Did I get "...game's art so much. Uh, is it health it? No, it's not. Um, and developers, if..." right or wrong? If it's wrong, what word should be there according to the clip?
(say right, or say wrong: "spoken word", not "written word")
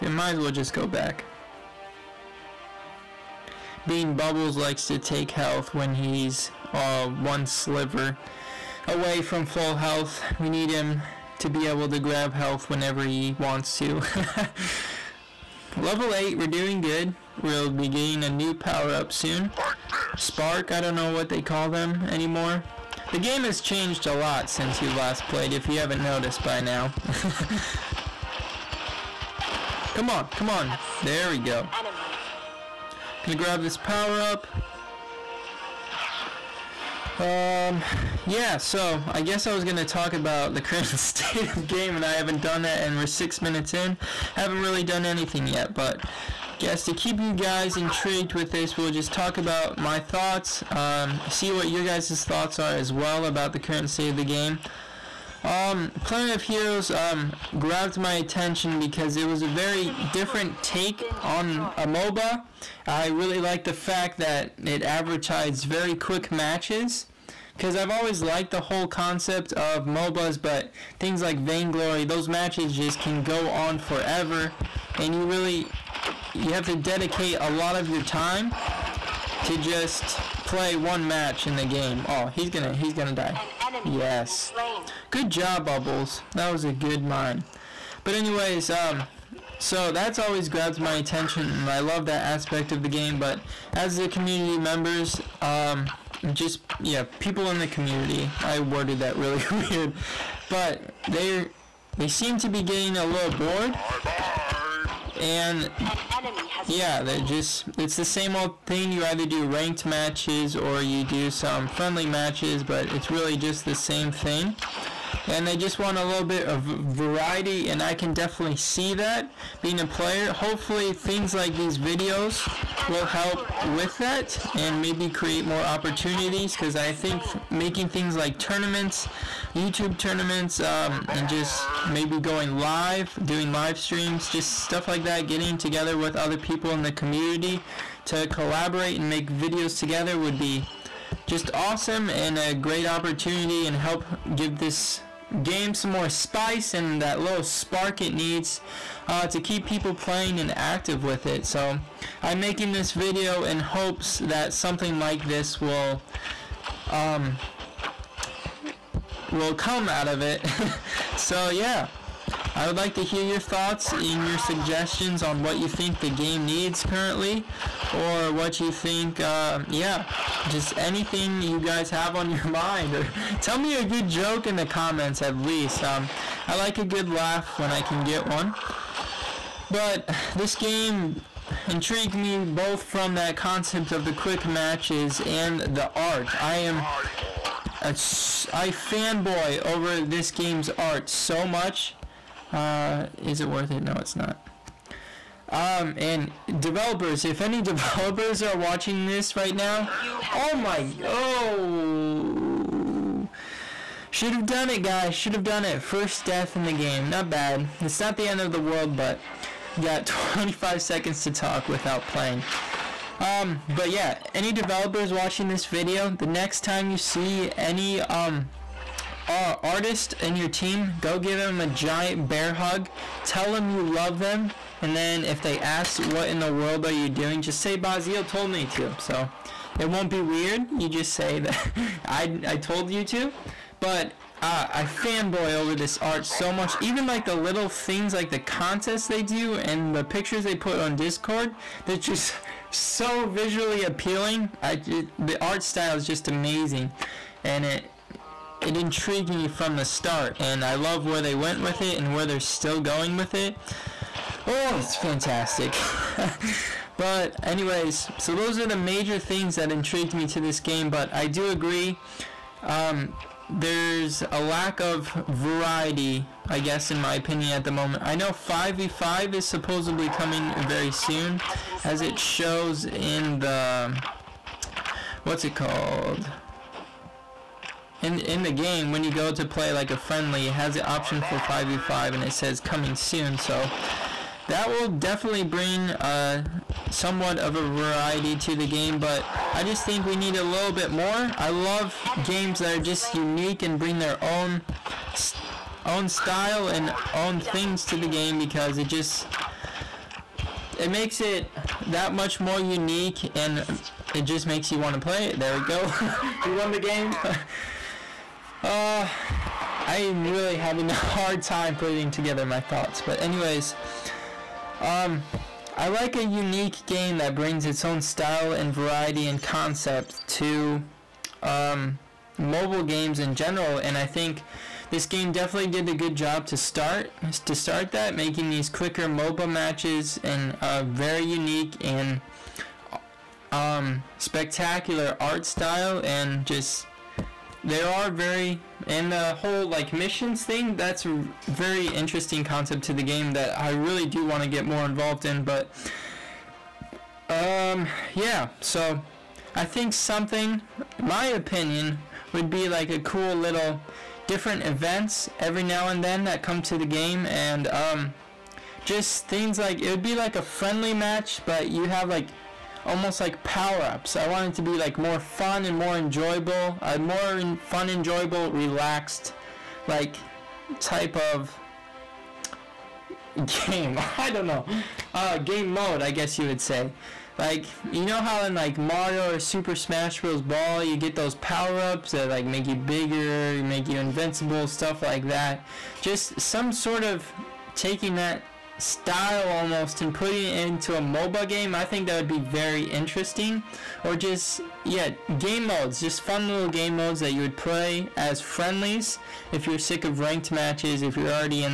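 wrong: "worth", not "health".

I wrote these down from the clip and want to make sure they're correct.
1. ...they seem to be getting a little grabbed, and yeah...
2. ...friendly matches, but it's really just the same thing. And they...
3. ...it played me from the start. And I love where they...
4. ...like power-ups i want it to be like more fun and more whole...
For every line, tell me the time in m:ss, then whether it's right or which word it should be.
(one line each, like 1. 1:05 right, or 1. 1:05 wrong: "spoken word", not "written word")
1. 1:41 wrong: "bored", not "grabbed"
2. 1:51 right
3. 4:08 wrong: "intrigued", not "played"
4. 6:03 wrong: "enjoyable", not "whole".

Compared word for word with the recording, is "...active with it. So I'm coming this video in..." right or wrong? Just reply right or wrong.
wrong.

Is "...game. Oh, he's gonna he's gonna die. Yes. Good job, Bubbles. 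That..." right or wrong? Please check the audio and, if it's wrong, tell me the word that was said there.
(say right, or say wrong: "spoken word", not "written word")
right.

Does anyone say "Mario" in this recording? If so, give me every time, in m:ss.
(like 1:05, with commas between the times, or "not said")
6:18.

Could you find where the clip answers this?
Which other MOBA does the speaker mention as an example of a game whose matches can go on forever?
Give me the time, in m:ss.
1:11.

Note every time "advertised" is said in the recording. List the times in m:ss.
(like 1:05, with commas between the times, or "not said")
1:04.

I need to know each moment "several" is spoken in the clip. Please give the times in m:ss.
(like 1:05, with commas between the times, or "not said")
not said.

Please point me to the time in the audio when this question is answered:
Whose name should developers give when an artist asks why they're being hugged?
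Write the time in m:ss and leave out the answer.
3:47.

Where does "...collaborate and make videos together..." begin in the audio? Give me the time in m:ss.
2:18.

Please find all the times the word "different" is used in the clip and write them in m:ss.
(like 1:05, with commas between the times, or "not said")
1:00, 5:54.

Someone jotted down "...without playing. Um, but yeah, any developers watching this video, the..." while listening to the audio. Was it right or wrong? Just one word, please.
right.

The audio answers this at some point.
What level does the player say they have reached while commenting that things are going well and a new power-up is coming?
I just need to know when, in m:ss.
0:15.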